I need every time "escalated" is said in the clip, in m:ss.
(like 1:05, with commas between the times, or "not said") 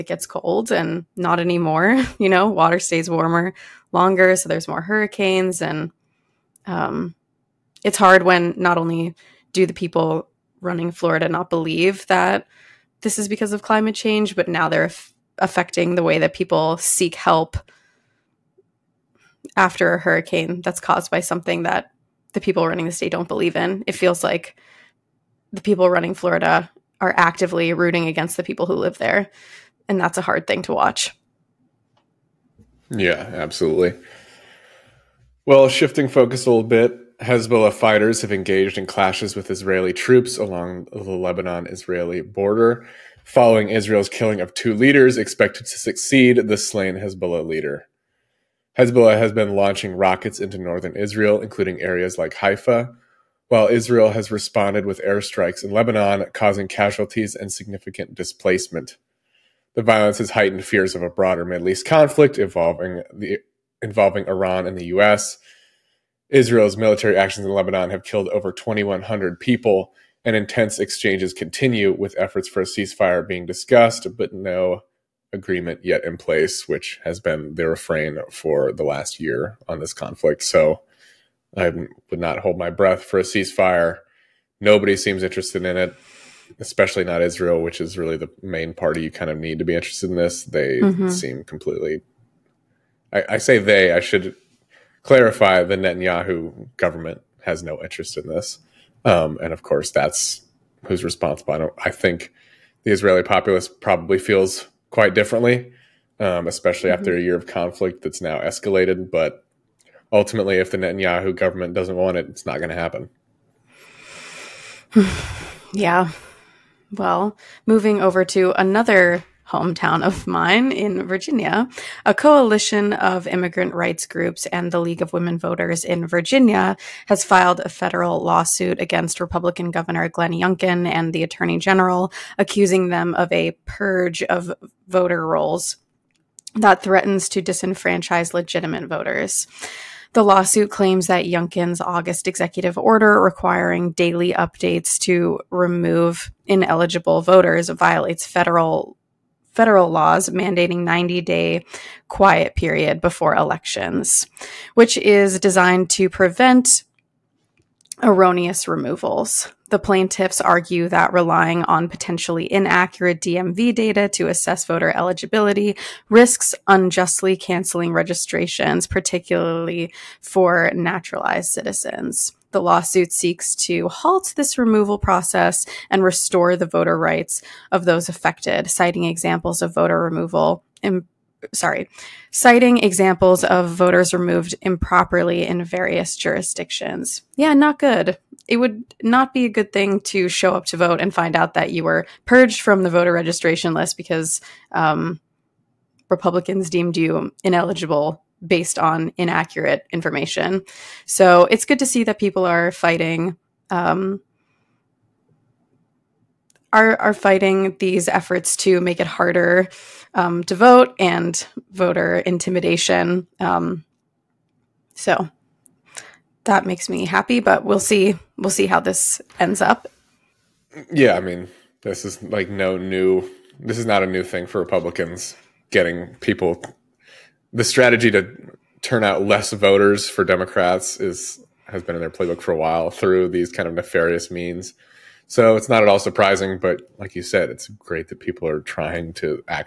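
1:48.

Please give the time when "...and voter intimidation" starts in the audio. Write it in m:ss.
3:30.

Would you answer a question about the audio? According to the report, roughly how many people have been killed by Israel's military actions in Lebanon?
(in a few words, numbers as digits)
over 2,100.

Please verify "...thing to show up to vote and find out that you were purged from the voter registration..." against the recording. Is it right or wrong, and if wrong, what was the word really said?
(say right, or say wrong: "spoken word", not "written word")
right.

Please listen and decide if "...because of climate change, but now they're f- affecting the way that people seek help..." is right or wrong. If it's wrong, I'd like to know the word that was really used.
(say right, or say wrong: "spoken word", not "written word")
right.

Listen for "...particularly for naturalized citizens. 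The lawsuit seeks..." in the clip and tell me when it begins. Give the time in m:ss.
2:48.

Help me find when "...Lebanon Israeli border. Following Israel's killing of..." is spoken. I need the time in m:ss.
0:40.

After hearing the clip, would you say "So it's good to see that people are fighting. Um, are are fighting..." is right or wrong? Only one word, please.
right.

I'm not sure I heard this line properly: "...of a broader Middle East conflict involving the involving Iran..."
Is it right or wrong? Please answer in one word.
right.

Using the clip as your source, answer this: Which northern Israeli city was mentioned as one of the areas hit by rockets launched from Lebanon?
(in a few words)
Haifa.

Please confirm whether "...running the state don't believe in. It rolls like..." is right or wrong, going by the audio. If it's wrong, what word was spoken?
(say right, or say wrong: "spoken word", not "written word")
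wrong: "feels", not "rolls".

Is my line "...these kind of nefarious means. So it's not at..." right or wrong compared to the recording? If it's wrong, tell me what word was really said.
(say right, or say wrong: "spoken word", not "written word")
right.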